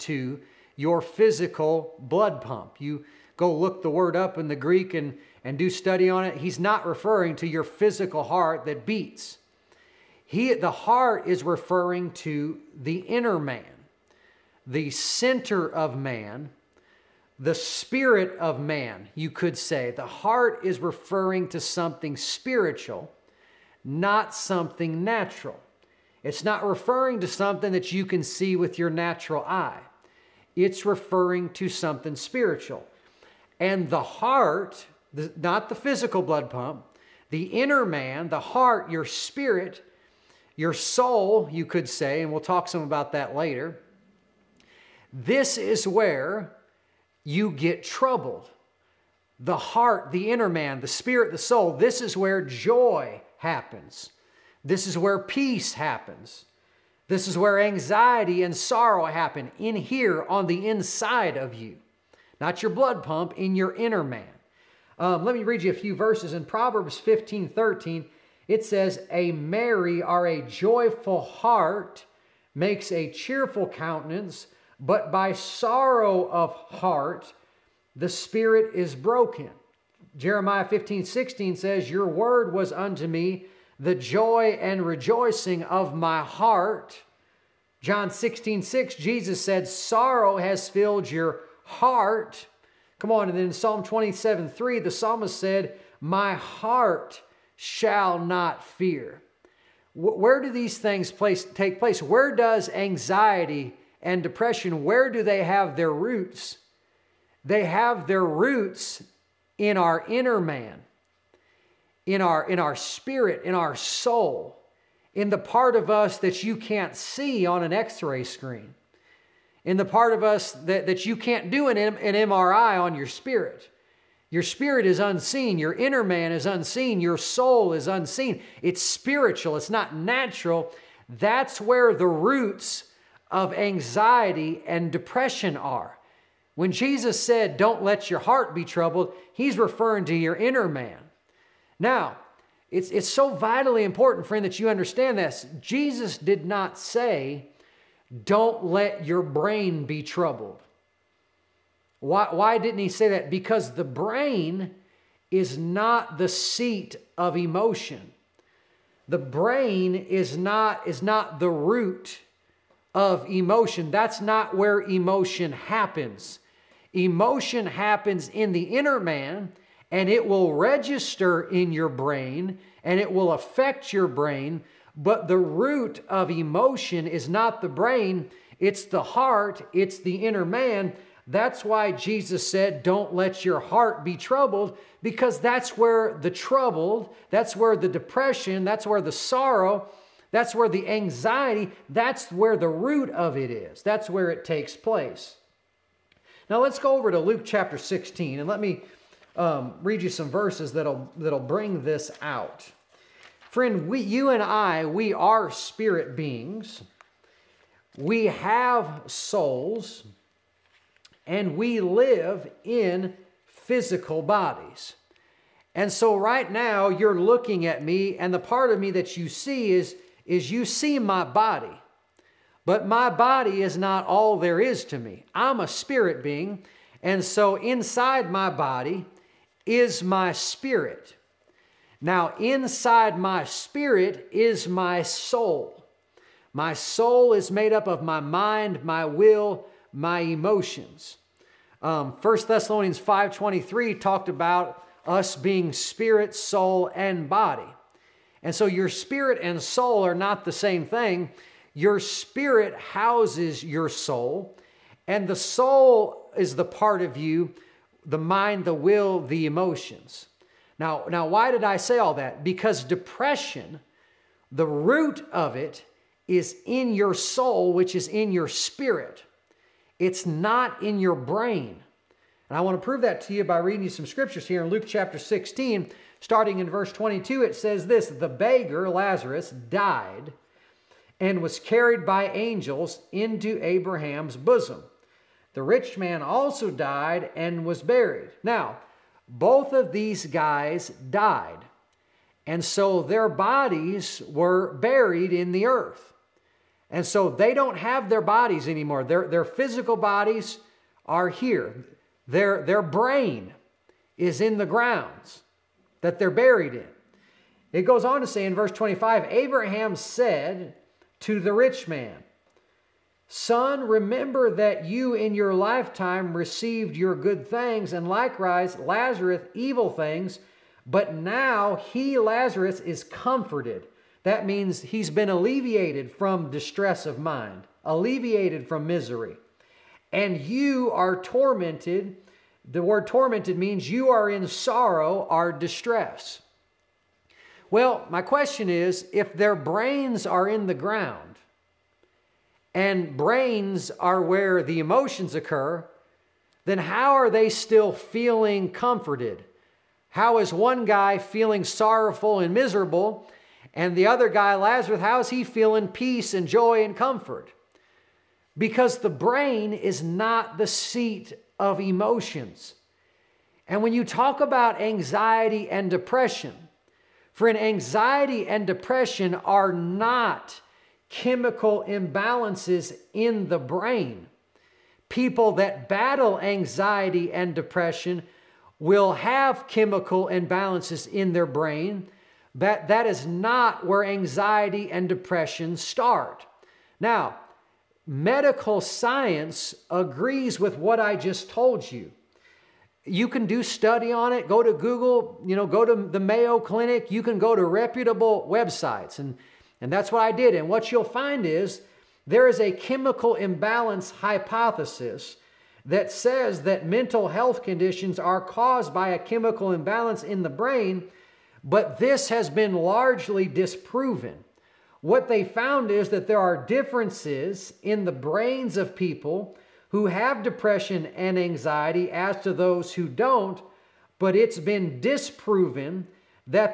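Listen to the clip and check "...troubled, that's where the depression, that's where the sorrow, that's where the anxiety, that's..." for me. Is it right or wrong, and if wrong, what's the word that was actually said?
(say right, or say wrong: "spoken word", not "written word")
right.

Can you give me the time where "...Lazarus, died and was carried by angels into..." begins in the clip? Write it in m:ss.
4:38.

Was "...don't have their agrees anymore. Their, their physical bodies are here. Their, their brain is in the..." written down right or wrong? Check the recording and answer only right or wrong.
wrong.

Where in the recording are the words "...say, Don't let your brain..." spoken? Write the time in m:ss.
2:26.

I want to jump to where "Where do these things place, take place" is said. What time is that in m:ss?
1:39.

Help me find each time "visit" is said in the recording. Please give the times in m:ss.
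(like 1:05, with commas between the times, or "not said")
not said.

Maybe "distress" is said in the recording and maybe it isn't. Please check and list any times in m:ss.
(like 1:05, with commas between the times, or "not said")
5:26, 5:35.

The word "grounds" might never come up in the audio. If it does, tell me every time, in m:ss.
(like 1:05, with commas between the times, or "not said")
5:04, 5:40.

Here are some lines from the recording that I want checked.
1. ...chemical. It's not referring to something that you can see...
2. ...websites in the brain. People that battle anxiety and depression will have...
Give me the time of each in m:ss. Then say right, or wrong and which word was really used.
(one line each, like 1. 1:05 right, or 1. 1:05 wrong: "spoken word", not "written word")
1. 0:25 wrong: "natural", not "chemical"
2. 6:11 wrong: "imbalances", not "websites".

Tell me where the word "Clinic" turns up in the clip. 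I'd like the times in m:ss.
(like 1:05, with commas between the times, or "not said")
6:36.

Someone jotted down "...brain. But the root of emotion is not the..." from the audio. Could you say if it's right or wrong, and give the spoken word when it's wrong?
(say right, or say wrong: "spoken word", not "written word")
right.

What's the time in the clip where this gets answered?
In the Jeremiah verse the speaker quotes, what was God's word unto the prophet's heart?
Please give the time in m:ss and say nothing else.
1:23.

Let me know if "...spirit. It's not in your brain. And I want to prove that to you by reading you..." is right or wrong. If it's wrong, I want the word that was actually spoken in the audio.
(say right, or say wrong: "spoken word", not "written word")
right.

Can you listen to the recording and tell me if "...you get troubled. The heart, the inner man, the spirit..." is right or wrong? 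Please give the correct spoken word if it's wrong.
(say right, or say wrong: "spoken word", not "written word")
right.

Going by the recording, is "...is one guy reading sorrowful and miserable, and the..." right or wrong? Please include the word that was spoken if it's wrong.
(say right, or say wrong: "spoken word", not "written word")
wrong: "feeling", not "reading".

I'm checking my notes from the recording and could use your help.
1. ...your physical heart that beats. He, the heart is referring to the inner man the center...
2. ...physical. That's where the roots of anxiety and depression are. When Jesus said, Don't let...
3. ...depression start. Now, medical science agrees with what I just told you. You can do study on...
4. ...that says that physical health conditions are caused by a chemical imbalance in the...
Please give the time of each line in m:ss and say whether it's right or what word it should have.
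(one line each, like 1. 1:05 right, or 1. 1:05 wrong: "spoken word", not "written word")
1. 0:07 right
2. 2:09 wrong: "natural", not "physical"
3. 6:25 right
4. 6:45 wrong: "mental", not "physical".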